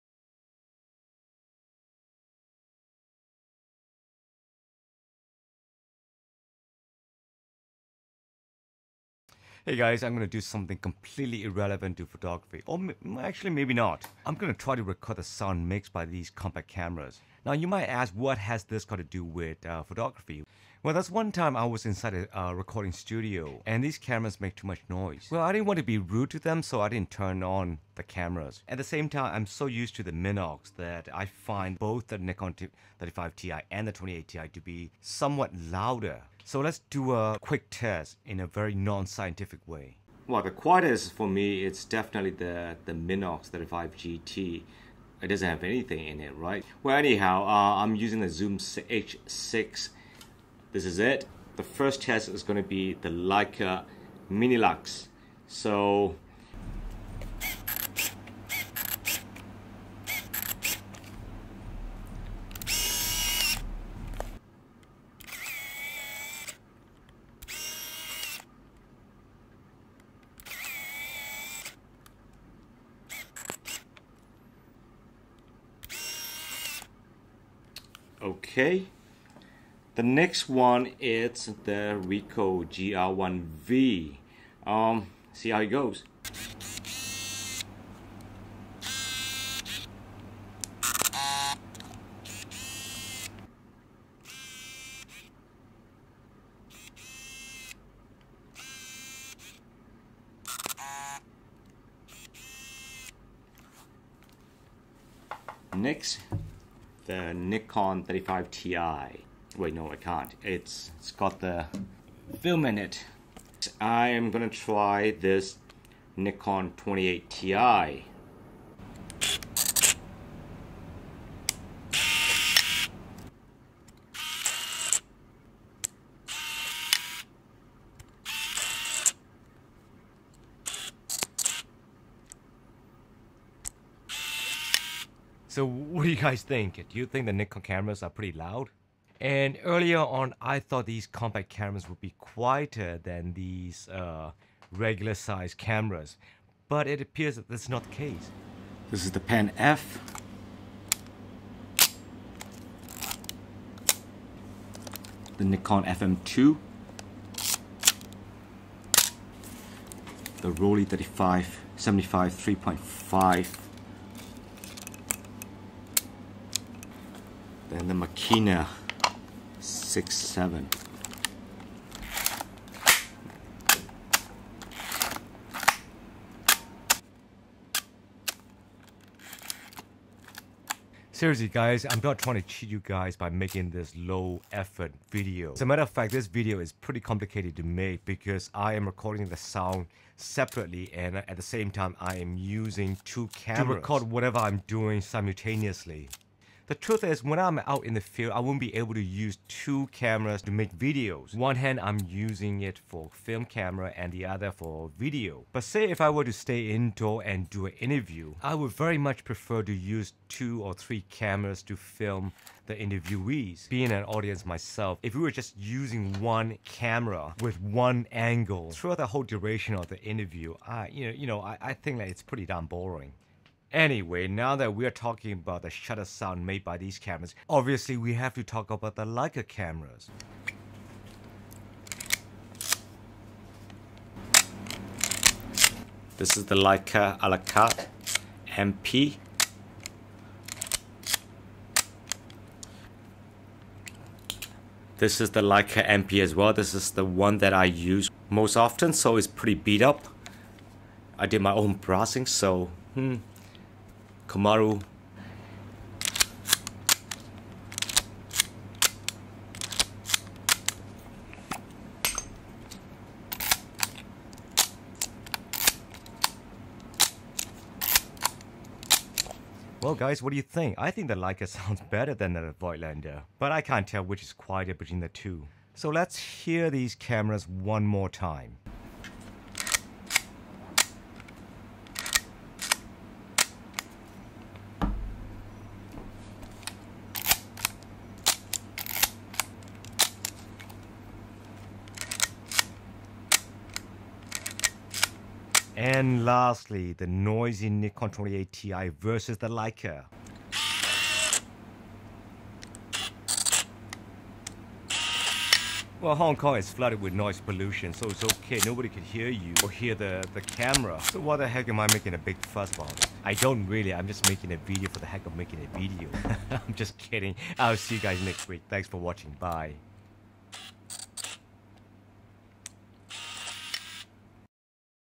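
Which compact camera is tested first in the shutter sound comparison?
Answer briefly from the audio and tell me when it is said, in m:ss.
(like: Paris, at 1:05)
Leica Minilux, at 0:53.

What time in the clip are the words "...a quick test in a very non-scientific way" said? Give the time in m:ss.
0:37.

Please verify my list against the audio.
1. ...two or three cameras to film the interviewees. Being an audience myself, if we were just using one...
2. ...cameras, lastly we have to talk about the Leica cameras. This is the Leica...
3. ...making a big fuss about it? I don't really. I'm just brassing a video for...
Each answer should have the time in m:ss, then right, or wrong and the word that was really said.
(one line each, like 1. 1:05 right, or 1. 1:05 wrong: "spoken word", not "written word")
1. 3:30 right
2. 3:46 wrong: "obviously", not "lastly"
3. 5:11 wrong: "making", not "brassing".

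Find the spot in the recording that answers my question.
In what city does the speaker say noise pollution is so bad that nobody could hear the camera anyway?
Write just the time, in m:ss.
5:06.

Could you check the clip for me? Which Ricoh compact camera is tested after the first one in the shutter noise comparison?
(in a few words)
Ricoh GR1V.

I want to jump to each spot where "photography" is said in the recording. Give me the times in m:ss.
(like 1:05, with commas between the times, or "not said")
0:12, 0:19.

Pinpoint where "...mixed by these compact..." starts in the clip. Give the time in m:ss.
0:15.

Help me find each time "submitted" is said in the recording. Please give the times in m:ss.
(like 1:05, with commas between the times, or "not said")
not said.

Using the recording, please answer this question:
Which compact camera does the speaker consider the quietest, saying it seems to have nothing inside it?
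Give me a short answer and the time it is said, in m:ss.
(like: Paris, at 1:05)
Minox 35 GT, at 0:42.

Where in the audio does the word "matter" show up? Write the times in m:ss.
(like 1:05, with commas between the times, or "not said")
3:05.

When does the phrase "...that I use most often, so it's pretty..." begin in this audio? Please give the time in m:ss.
4:07.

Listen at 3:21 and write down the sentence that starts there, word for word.
One hand, I'm using it for film camera and the other for video.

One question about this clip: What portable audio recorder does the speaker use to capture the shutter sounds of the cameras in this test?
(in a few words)
Zoom H6.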